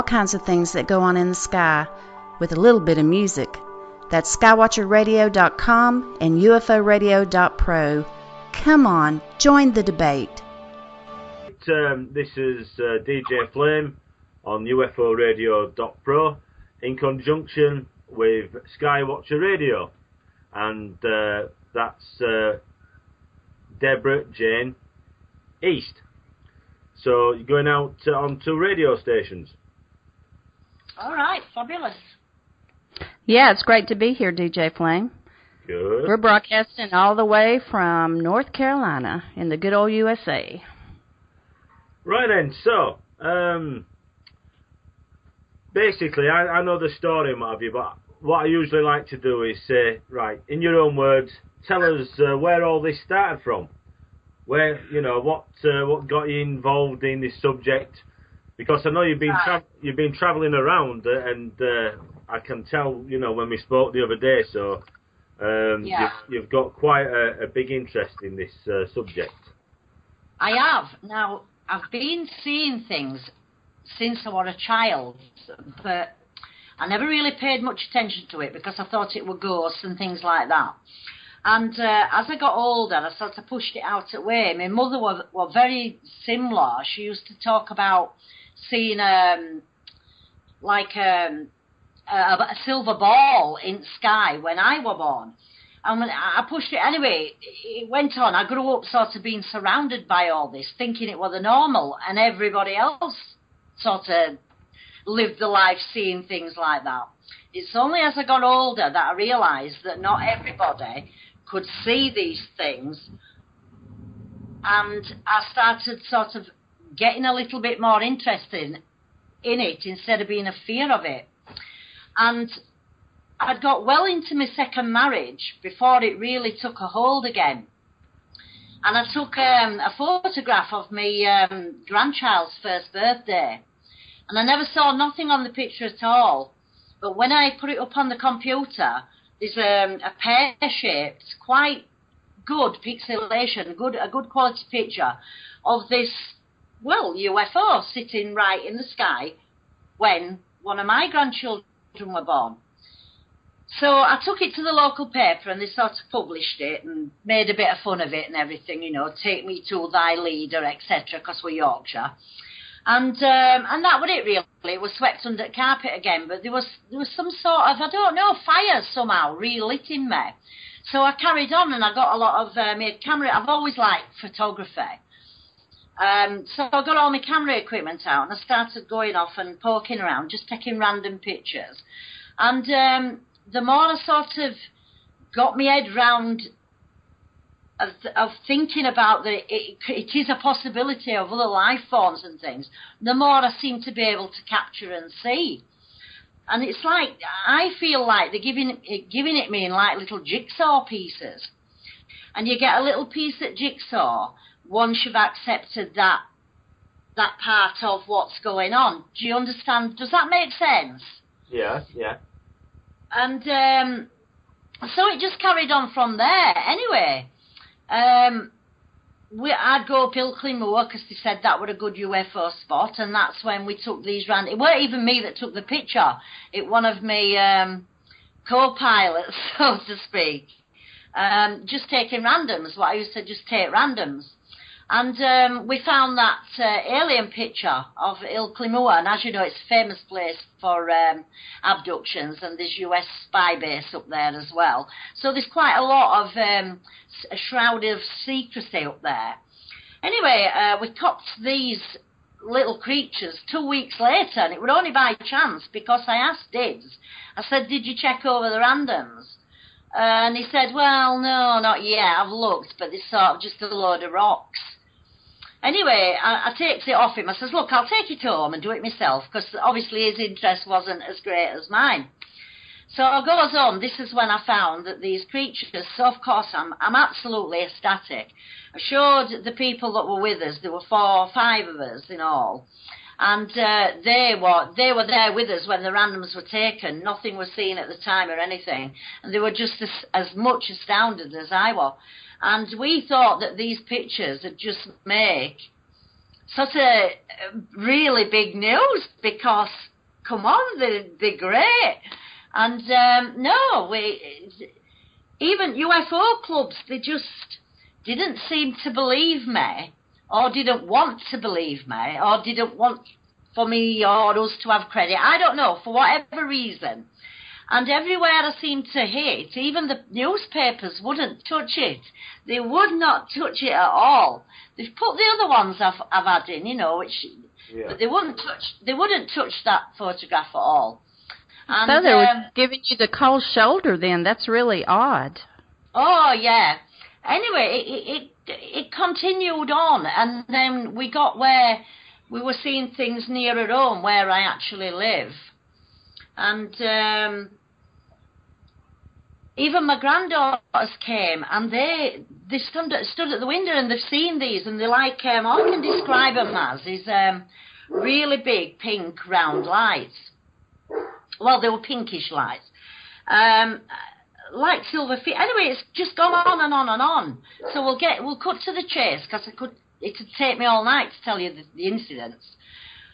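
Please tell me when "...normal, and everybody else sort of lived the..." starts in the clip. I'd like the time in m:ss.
1:41.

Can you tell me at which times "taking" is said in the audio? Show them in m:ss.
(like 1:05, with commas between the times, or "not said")
3:00, 3:51.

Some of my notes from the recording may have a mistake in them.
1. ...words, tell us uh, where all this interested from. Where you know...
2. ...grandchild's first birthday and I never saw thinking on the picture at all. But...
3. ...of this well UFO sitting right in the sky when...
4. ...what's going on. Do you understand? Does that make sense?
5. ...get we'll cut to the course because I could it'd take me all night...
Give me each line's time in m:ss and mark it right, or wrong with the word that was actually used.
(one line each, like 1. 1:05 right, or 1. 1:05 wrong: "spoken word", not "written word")
1. 0:50 wrong: "started", not "interested"
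2. 2:11 wrong: "nothing", not "thinking"
3. 2:25 right
4. 3:28 right
5. 6:07 wrong: "chase", not "course".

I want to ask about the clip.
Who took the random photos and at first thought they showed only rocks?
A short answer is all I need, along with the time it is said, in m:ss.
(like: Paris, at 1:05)
Dibs, at 4:16.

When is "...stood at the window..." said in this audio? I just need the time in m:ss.
5:53.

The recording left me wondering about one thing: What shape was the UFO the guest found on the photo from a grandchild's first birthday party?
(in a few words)
Pear-shaped.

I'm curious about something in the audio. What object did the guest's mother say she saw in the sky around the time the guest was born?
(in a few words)
A silver ball.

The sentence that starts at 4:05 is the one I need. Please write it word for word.
So there's quite a lot of um, a shroud of secrecy up there.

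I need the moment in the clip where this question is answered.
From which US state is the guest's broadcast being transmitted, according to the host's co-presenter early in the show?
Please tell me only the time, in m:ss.
0:38.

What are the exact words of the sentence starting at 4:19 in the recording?
Uh, and he said, Well, no, not yet.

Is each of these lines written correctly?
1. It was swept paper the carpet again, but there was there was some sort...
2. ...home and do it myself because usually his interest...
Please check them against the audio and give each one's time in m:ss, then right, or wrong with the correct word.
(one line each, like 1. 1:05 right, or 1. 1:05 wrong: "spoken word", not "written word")
1. 2:44 wrong: "under", not "paper"
2. 4:28 wrong: "obviously", not "usually".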